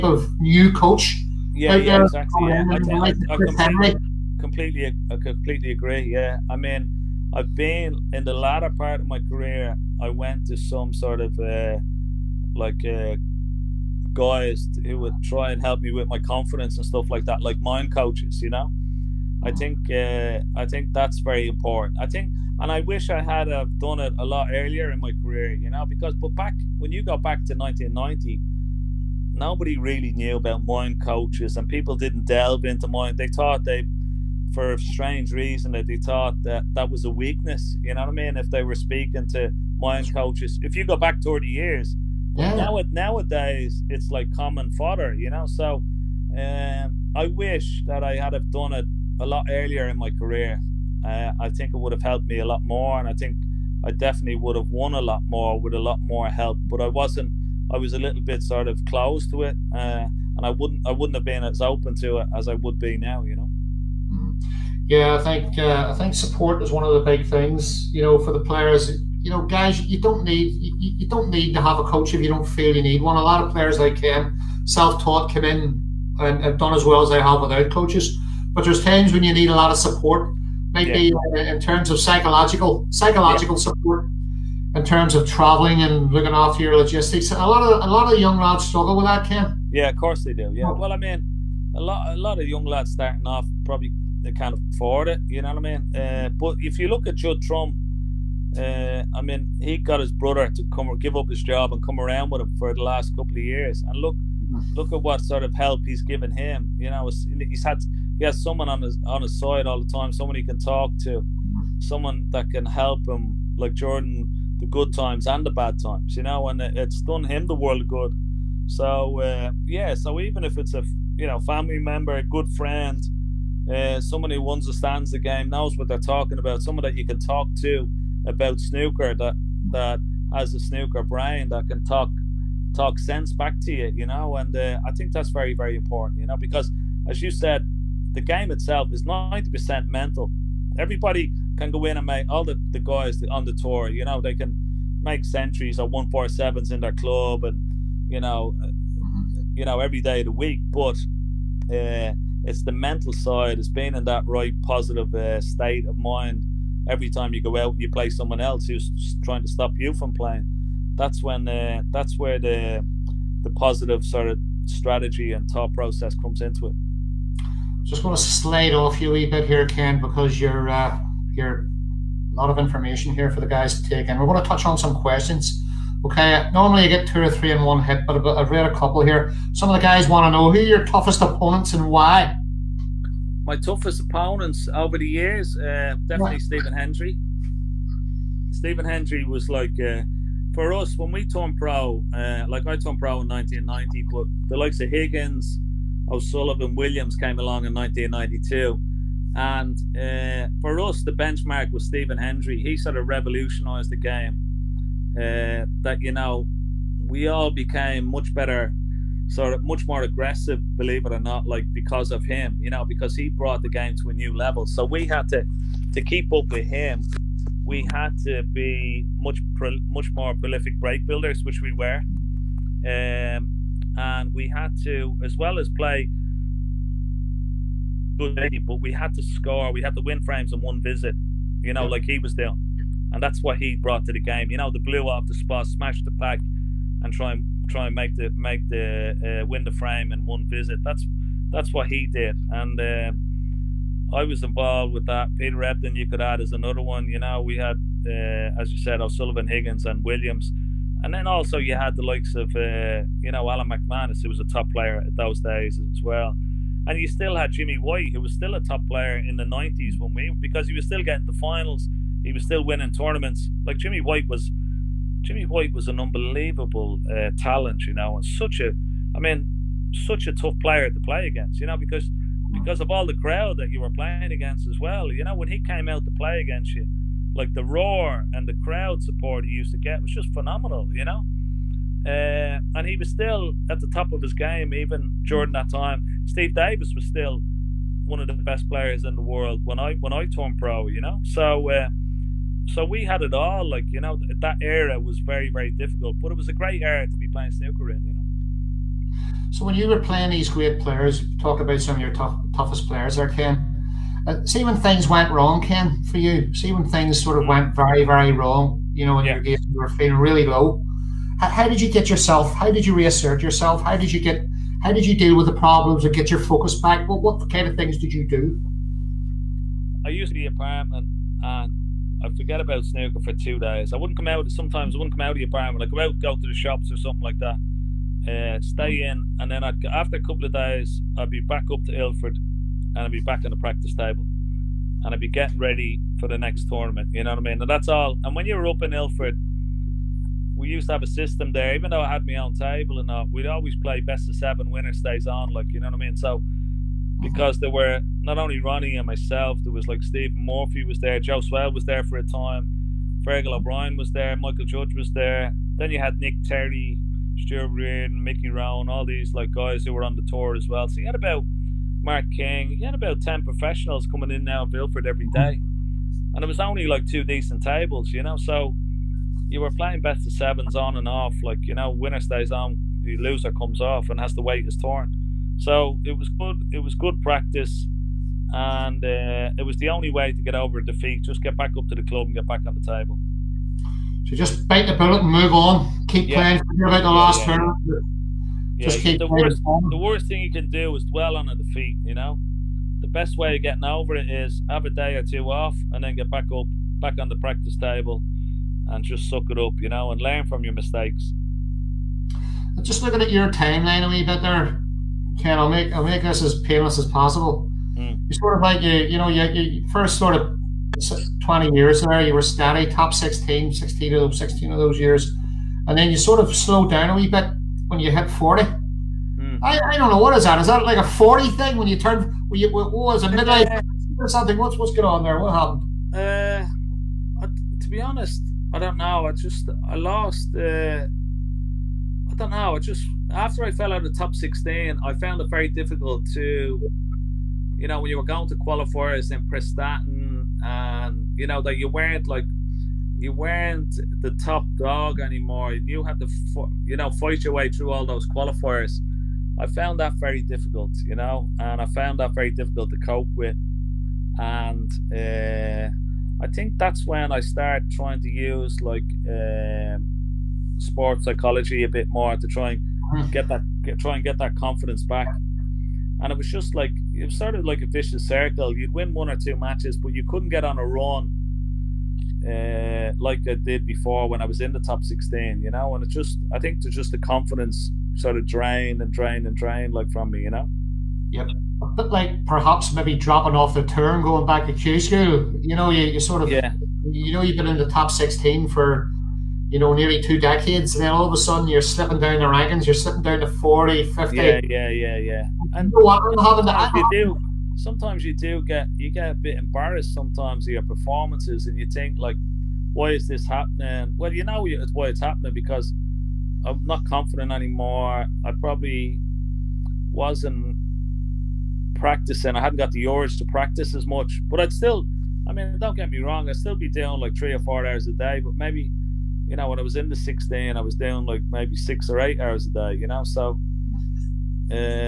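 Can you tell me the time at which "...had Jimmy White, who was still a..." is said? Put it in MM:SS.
04:17.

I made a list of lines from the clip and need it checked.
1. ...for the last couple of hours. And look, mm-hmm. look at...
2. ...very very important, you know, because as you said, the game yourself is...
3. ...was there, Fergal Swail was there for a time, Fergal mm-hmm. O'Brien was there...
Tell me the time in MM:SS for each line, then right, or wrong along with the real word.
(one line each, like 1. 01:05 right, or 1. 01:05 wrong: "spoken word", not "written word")
1. 01:42 wrong: "years", not "hours"
2. 02:15 wrong: "itself", not "yourself"
3. 05:50 wrong: "Joe", not "Fergal".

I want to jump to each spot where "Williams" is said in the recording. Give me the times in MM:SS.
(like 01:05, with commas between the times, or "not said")
03:16, 04:10.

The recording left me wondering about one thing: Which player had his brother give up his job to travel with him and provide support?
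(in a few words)
Judd Trump.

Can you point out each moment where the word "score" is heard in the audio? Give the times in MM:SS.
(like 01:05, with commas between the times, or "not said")
03:49.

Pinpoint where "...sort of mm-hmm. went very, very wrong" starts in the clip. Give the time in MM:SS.
05:07.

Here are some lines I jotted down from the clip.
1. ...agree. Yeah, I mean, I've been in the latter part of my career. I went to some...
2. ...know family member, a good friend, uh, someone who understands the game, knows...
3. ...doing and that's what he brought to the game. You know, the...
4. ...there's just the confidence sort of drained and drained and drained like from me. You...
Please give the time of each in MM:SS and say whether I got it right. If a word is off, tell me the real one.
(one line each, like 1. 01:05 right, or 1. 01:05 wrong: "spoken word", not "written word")
1. 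00:05 right
2. 02:01 right
3. 03:52 right
4. 07:56 right.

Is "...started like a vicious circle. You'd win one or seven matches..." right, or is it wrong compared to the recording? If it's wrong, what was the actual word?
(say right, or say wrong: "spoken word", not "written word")
wrong: "two", not "seven".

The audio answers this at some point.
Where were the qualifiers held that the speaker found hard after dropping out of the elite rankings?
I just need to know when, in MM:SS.
07:19.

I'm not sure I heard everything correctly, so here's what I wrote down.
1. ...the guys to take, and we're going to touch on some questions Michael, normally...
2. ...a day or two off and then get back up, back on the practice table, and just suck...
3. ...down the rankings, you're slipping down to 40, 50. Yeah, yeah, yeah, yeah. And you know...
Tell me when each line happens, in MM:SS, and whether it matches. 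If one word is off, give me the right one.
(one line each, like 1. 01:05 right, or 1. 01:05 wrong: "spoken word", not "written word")
1. 02:53 wrong: "Okay", not "Michael"
2. 06:34 right
3. 08:12 right.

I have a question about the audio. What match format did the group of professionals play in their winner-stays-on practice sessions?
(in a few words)
Best of seven.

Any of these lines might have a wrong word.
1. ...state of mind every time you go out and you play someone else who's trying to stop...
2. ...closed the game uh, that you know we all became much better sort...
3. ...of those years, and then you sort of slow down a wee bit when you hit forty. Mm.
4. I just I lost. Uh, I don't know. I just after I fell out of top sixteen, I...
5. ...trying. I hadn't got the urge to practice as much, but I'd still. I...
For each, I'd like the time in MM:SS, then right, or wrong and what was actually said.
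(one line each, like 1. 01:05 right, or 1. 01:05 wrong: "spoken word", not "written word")
1. 02:35 right
2. 03:23 wrong: "revolutionized", not "closed"
3. 06:54 right
4. 07:09 right
5. 08:31 wrong: "practicing", not "trying".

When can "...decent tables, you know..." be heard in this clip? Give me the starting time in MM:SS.
06:07.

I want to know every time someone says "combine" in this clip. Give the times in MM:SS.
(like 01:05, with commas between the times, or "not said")
not said.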